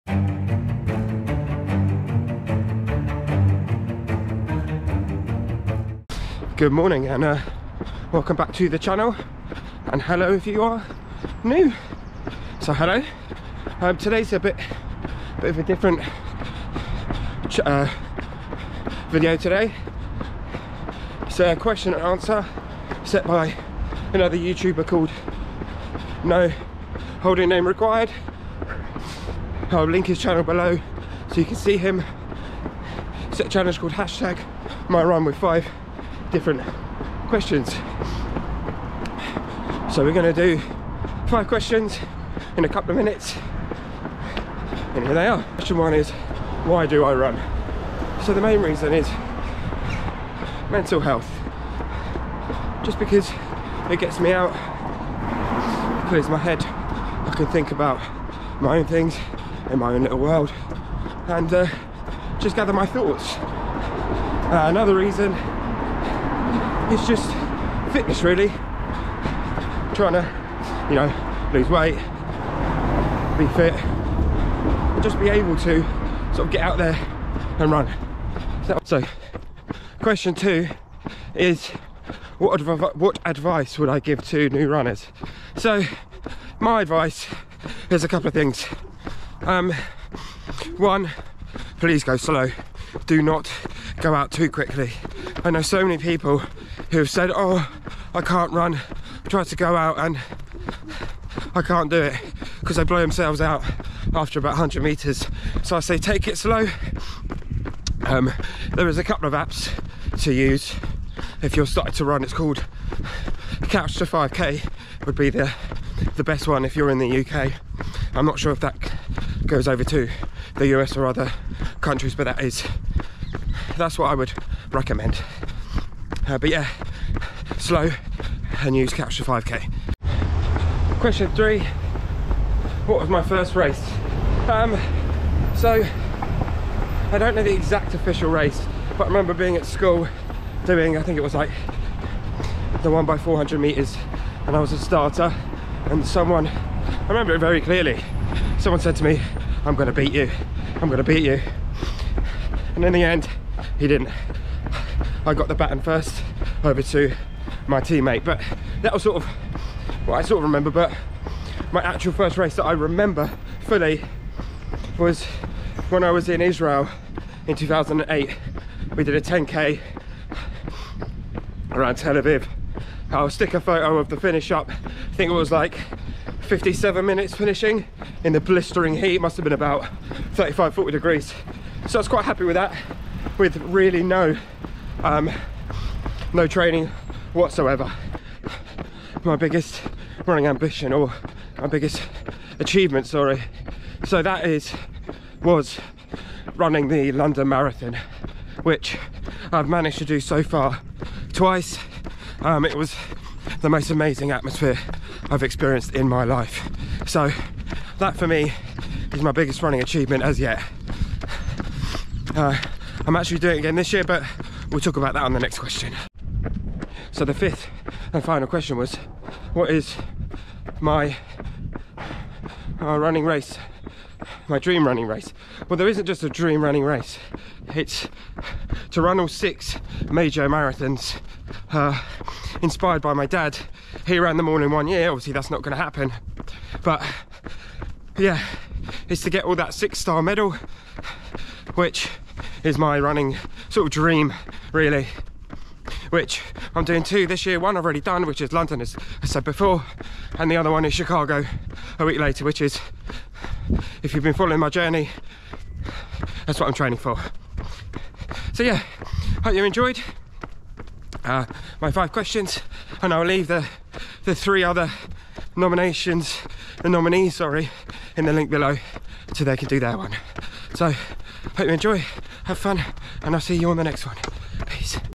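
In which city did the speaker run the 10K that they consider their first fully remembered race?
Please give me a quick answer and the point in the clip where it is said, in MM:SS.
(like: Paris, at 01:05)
Tel Aviv, at 02:51.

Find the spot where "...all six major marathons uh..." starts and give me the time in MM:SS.
03:49.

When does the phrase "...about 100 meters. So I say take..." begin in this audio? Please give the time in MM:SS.
01:44.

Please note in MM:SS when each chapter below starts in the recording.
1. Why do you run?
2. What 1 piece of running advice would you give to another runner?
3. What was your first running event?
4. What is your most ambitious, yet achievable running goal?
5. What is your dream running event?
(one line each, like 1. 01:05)
1. 00:44
2. 01:18
3. 02:10
4. 03:08
5. 03:36.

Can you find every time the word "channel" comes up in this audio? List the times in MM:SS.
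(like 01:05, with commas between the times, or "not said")
00:08, 00:30.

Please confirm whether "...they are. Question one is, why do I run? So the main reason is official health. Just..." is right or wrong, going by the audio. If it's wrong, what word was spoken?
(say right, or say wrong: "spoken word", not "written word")
wrong: "mental", not "official".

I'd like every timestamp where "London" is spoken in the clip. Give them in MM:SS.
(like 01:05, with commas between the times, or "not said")
03:17, 04:08.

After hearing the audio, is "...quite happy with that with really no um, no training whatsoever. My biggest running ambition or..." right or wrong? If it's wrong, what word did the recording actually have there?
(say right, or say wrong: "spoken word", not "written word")
right.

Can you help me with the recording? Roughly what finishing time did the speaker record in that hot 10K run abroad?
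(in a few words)
57 minutes.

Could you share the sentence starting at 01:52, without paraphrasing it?
It's called Couch to 5K would be the, the best one if you're in the UK.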